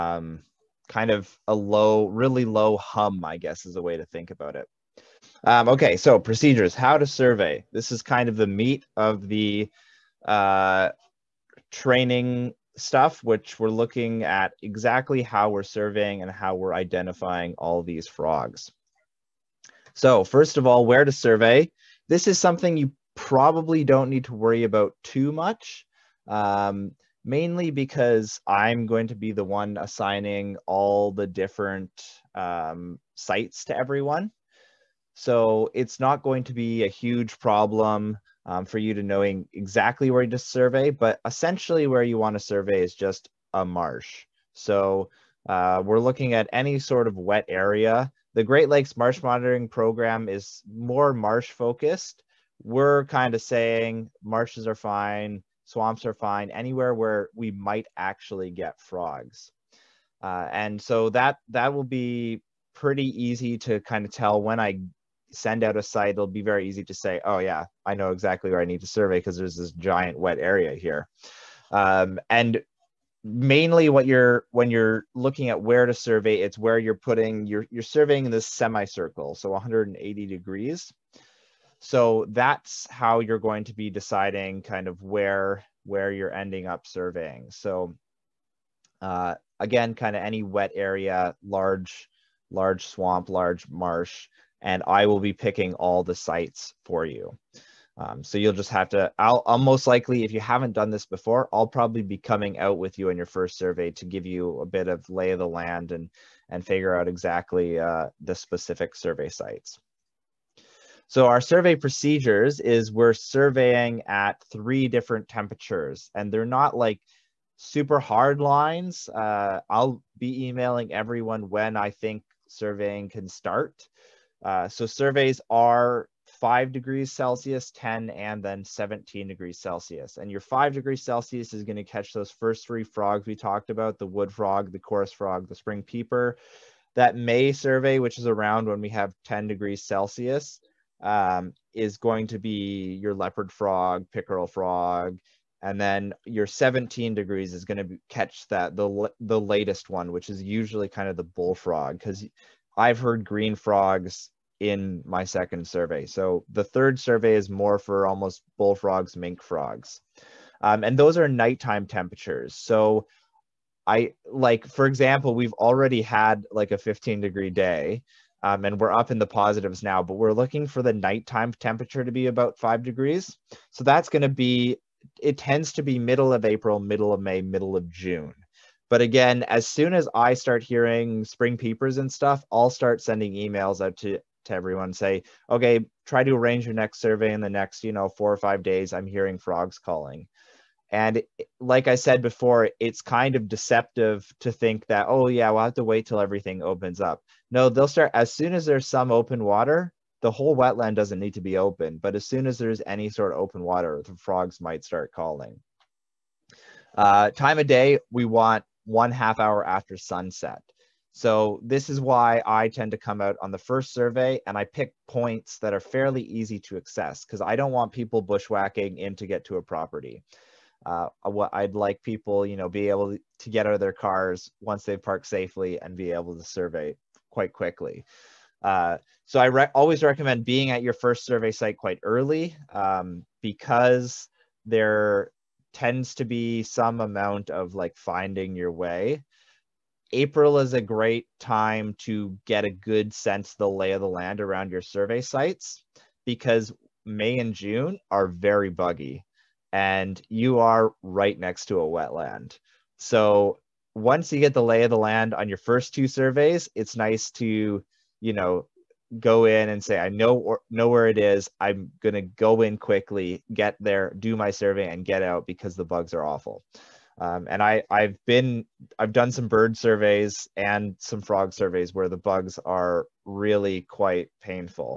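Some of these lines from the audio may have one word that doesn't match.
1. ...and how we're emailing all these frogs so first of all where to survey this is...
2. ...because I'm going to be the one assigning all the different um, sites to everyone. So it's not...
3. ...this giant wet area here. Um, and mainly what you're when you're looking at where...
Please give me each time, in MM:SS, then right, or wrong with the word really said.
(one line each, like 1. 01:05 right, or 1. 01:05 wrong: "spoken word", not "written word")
1. 00:16 wrong: "identifying", not "emailing"
2. 00:27 right
3. 01:09 right.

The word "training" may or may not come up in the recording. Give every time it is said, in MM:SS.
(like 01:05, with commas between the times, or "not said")
00:11.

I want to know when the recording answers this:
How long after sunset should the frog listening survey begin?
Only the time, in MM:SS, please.
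03:28.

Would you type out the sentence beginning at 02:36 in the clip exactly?
So the third survey is more for almost bullfrogs, mink frogs, um, and those are nighttime temperatures.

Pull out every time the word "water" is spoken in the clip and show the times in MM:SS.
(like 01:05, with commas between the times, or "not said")
03:19, 03:23.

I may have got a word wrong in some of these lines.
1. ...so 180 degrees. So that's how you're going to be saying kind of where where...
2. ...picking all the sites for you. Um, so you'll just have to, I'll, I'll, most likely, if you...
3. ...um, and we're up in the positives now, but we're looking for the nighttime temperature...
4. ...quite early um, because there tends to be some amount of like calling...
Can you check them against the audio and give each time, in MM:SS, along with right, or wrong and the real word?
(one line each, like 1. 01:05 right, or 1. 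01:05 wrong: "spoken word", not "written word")
1. 01:19 wrong: "deciding", not "saying"
2. 01:35 right
3. 02:48 right
4. 03:51 wrong: "finding", not "calling".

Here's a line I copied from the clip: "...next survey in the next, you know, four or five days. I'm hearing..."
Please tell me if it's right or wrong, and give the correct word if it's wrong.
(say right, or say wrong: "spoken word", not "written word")
right.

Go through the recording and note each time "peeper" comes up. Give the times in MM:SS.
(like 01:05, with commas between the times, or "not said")
02:15, 03:01.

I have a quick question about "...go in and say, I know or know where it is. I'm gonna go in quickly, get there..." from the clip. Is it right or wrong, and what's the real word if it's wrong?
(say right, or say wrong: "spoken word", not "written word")
right.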